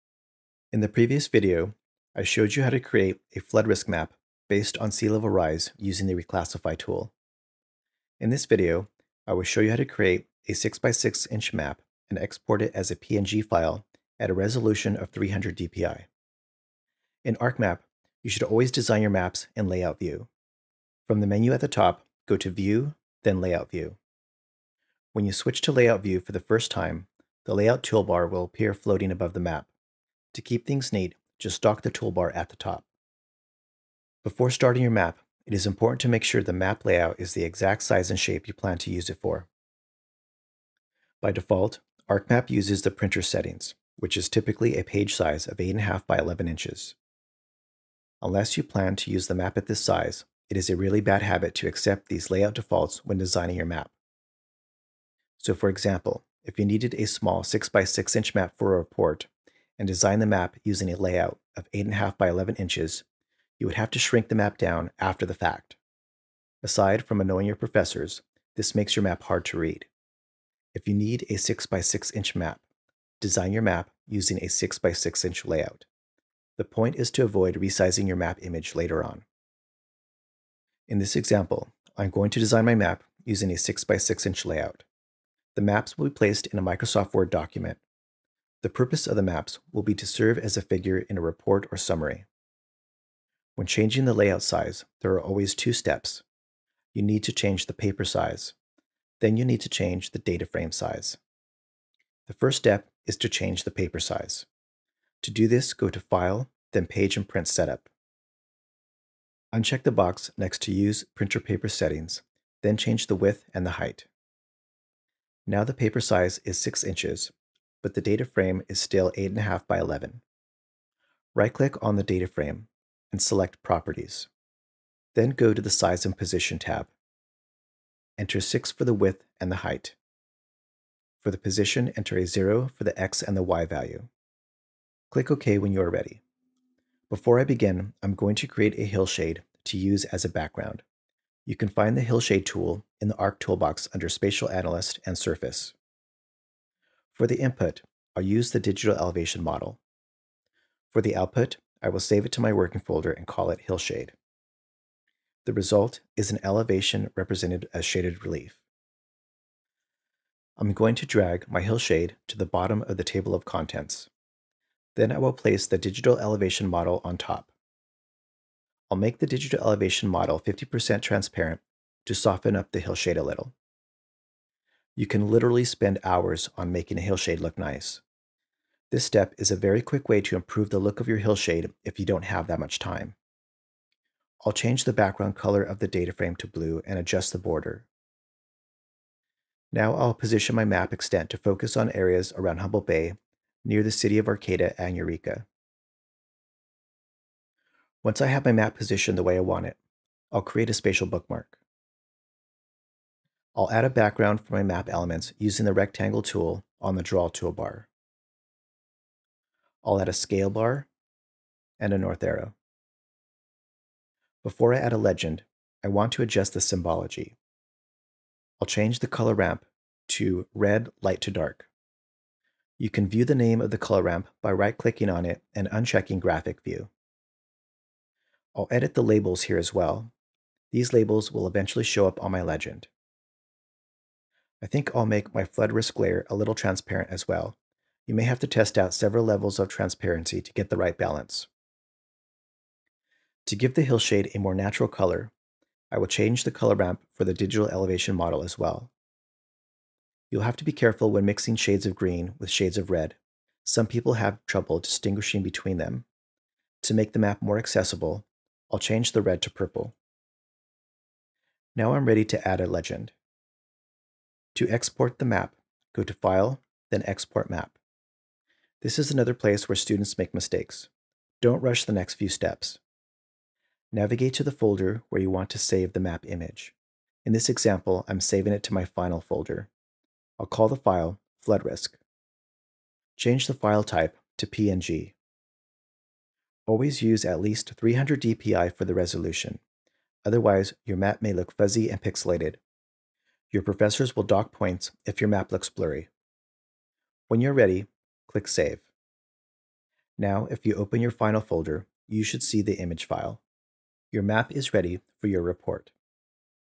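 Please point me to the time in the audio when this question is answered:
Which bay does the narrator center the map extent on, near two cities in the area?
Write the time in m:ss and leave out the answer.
3:12.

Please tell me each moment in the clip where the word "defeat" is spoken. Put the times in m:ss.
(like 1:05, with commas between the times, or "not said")
not said.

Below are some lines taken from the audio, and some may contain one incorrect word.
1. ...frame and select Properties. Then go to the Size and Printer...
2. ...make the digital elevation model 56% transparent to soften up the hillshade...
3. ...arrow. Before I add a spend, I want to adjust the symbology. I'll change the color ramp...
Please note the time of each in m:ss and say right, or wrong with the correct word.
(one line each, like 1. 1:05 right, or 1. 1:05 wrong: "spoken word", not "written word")
1. 2:02 wrong: "Position", not "Printer"
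2. 2:48 wrong: "50", not "56"
3. 3:32 wrong: "legend", not "spend".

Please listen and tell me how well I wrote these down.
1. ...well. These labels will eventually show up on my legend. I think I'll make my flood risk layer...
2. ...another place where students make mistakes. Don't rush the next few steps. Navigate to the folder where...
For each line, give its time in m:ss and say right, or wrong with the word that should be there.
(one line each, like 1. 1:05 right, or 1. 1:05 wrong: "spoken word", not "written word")
1. 3:49 right
2. 4:29 right.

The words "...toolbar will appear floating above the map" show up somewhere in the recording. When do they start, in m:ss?
0:27.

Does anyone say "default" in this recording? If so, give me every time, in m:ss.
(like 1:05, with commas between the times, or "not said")
0:41, 0:52.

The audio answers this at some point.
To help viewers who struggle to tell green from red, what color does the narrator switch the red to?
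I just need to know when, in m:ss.
4:19.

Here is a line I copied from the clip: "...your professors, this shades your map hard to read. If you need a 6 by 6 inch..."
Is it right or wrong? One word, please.
wrong.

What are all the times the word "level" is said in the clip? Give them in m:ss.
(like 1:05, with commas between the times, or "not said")
0:05, 3:59.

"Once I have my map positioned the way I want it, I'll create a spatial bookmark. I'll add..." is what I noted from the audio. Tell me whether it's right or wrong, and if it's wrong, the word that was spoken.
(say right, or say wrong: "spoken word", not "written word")
right.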